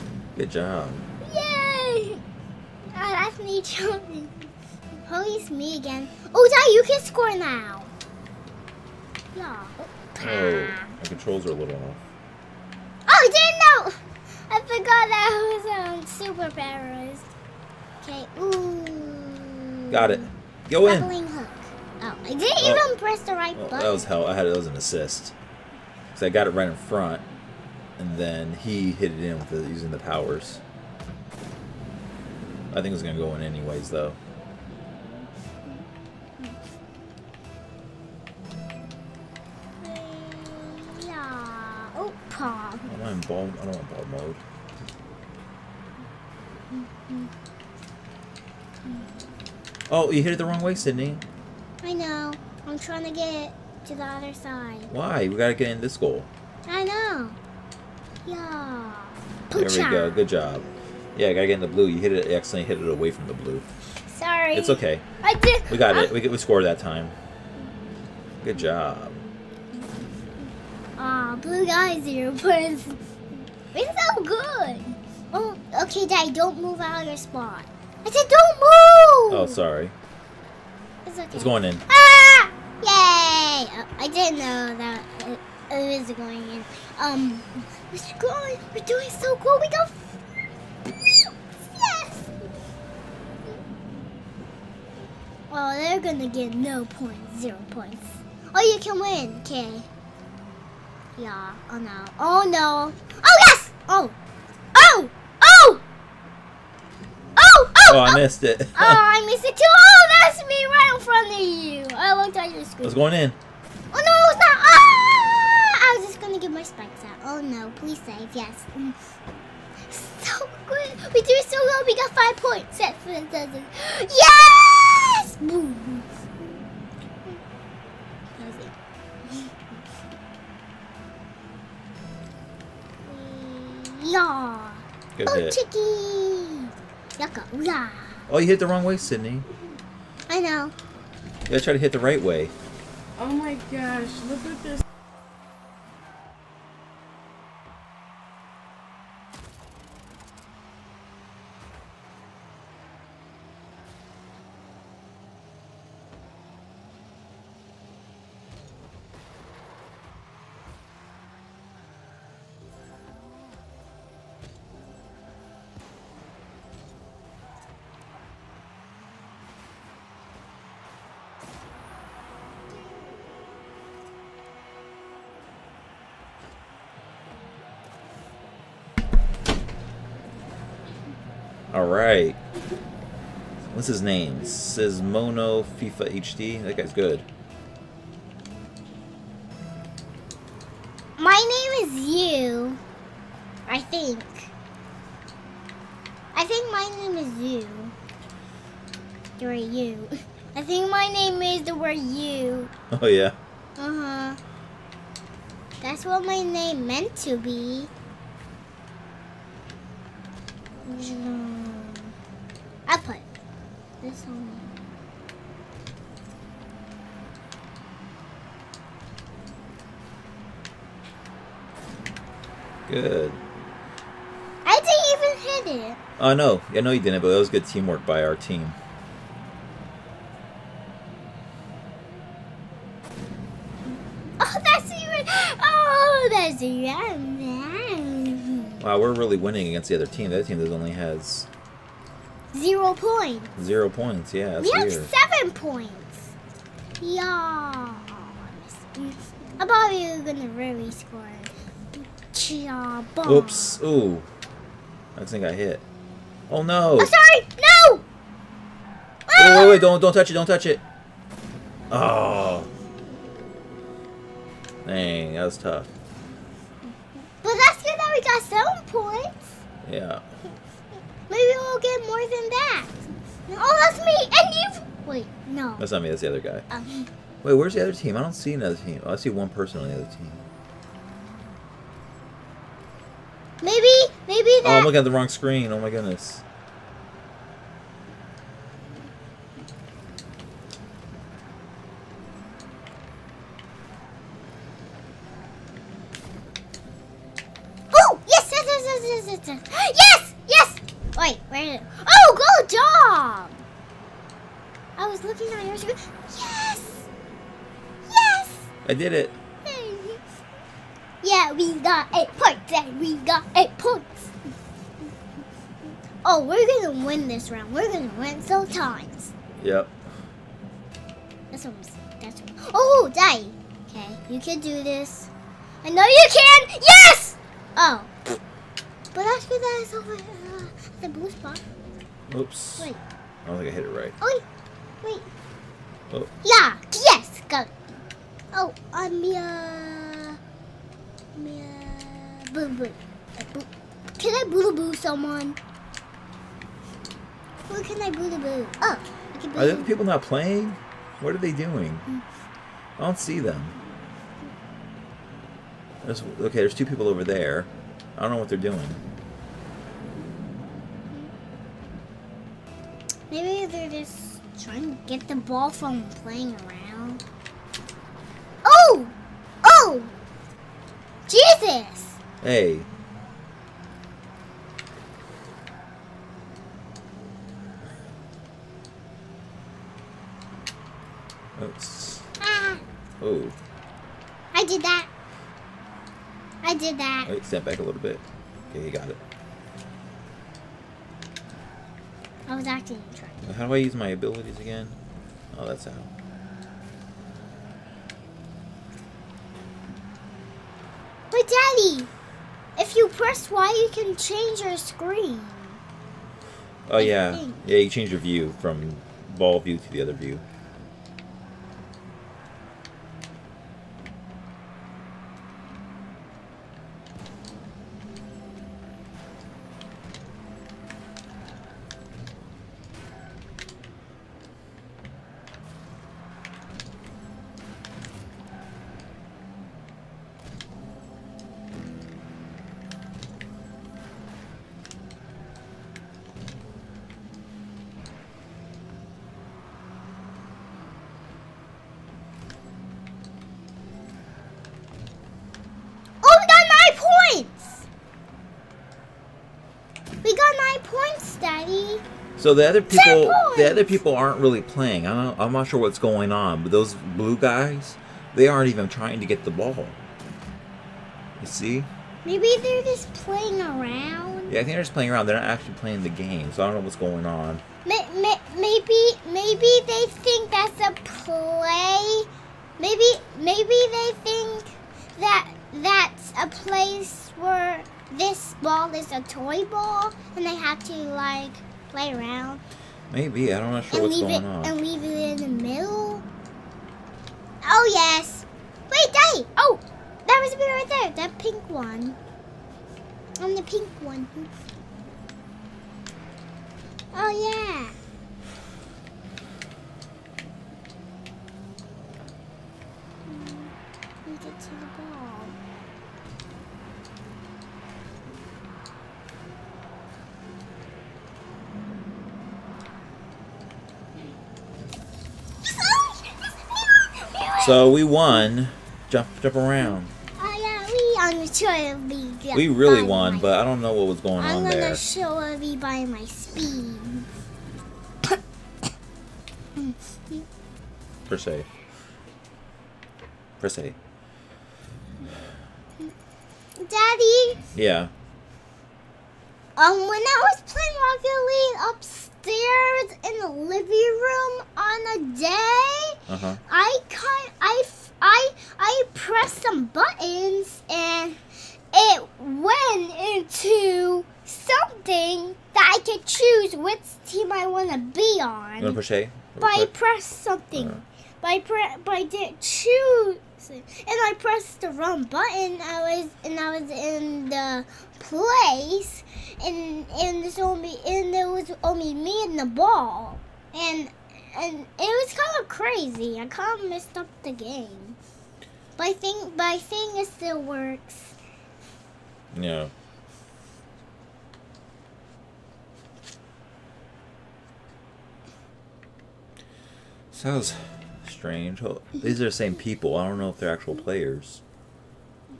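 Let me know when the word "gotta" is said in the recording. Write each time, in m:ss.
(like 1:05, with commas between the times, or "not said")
0:55, 1:01, 2:21.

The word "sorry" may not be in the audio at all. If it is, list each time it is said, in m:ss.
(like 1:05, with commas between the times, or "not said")
1:04, 1:19, 4:17.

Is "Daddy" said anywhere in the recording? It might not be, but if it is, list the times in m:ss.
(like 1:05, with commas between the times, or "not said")
5:23, 6:41, 8:09, 8:56.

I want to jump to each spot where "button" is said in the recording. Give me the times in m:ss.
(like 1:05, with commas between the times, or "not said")
0:23, 9:09, 9:25.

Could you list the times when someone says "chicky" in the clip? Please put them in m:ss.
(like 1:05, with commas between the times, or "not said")
2:15.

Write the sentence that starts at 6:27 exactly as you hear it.
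Wait, step back a little bit.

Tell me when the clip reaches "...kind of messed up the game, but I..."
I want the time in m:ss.
9:36.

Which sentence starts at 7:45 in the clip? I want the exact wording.
They're not actually playing the game, so I don't know what's going on.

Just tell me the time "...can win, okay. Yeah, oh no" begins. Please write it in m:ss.
1:38.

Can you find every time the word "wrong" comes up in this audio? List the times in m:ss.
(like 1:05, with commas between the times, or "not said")
0:50, 2:18, 4:45, 9:24.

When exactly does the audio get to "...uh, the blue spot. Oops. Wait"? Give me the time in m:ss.
5:30.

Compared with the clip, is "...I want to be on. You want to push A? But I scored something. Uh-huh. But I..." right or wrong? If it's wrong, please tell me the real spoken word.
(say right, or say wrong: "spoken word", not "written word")
wrong: "pressed", not "scored".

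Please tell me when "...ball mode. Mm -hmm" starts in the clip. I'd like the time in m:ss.
0:43.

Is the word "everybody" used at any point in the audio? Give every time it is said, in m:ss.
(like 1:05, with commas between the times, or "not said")
8:45.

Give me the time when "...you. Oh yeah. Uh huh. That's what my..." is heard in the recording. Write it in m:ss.
3:21.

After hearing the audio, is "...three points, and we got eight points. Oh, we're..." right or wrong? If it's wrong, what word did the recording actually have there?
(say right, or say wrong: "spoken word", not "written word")
wrong: "eight", not "three".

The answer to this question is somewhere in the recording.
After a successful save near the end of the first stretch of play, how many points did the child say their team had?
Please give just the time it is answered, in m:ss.
2:02.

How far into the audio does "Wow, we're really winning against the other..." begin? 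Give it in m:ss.
3:58.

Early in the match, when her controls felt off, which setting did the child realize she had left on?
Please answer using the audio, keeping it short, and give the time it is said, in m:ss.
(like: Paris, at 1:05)
super paralyzed, at 0:16.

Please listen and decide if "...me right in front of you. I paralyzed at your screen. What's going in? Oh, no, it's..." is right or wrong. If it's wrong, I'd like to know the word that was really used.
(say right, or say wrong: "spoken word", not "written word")
wrong: "looked", not "paralyzed".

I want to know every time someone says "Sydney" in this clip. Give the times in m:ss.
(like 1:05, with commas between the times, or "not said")
0:50, 2:18.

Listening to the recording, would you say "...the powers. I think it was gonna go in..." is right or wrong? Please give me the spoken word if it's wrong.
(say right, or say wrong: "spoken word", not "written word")
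right.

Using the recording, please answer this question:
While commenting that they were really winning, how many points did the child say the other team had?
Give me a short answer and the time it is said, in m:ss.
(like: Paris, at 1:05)
7, at 4:05.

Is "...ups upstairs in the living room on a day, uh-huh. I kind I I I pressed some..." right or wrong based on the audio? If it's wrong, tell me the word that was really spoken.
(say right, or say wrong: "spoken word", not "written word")
right.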